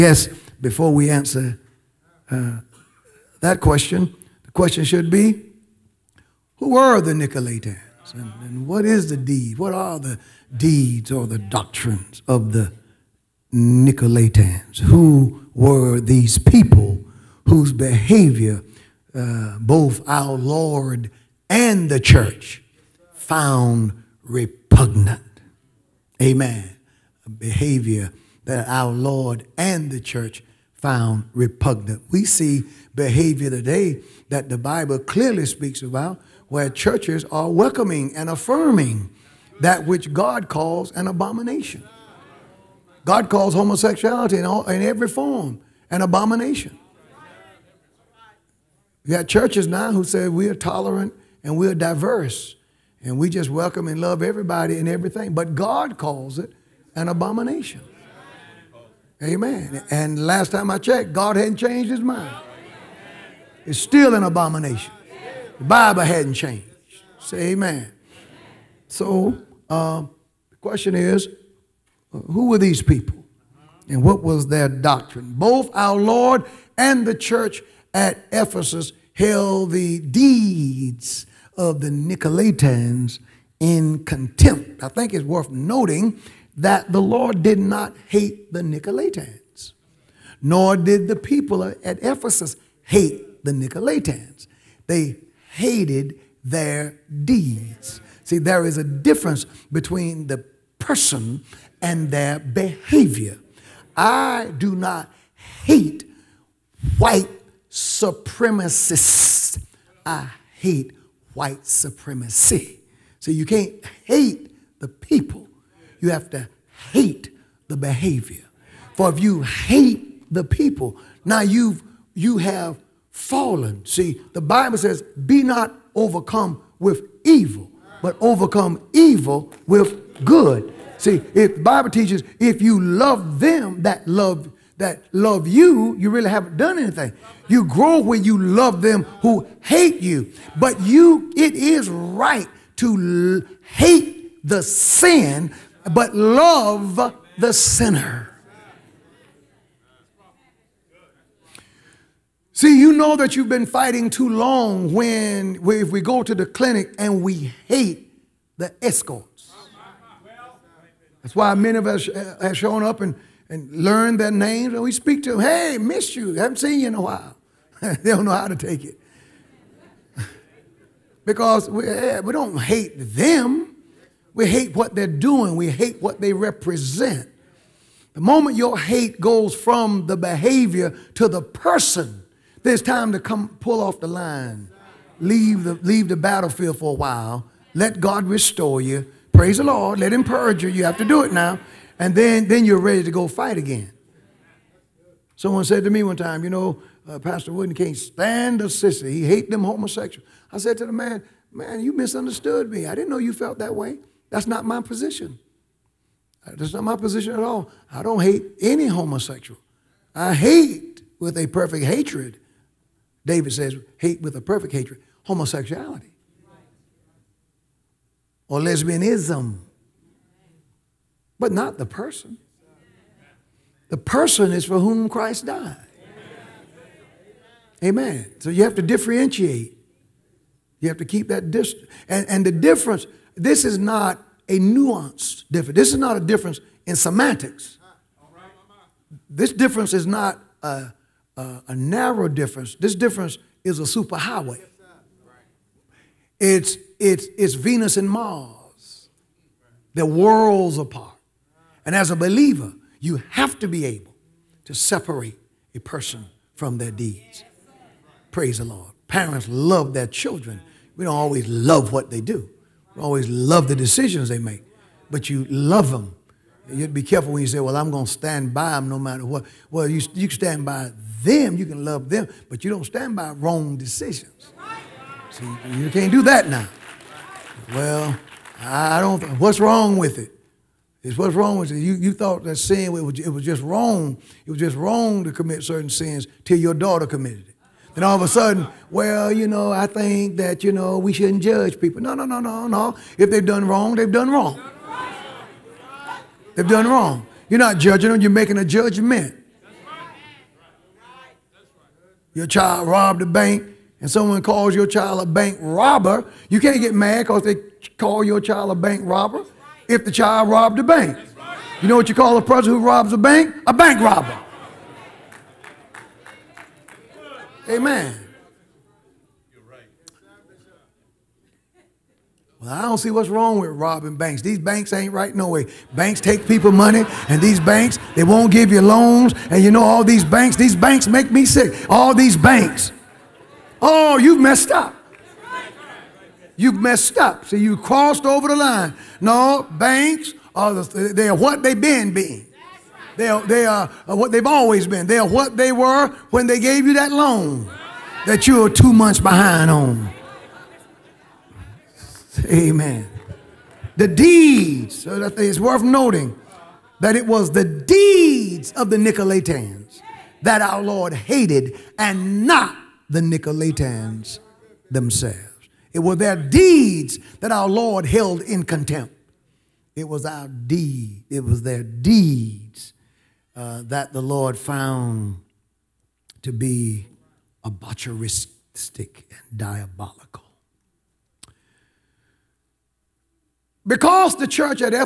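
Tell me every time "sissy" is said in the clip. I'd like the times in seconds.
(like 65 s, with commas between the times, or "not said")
198 s.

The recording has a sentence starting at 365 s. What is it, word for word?
It were their deeds that our Lord held in contempt.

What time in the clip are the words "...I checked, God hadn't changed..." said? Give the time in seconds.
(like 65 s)
60 s.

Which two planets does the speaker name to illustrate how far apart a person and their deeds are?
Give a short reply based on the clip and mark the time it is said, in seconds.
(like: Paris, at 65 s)
Venus and Mars, at 247 s.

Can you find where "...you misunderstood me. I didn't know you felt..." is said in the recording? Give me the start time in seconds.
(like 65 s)
201 s.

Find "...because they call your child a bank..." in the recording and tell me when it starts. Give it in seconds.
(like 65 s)
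307 s.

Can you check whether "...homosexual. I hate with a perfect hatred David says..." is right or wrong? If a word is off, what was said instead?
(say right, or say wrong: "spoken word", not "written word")
right.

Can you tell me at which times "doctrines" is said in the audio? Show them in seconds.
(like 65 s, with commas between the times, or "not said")
11 s, 74 s.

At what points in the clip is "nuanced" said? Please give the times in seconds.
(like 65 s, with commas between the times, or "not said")
234 s.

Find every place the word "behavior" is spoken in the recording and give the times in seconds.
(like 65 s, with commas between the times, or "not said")
17 s, 27 s, 32 s, 102 s, 117 s, 180 s.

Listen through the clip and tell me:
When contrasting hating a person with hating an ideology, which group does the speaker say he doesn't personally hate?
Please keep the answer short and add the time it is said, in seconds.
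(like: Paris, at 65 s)
White supremacists, at 106 s.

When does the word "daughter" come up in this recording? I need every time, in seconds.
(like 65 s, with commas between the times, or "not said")
286 s.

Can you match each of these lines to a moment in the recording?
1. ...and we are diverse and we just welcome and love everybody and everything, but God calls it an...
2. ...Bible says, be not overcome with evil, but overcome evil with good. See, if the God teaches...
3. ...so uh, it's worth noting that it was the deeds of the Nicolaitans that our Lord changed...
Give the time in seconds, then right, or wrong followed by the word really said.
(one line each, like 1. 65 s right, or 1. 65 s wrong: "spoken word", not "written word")
1. 51 s right
2. 124 s wrong: "Bible", not "God"
3. 355 s wrong: "hated", not "changed".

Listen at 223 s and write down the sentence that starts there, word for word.
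The person is for whom Christ died.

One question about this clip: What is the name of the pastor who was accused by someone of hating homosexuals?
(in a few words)
Pastor Wooden.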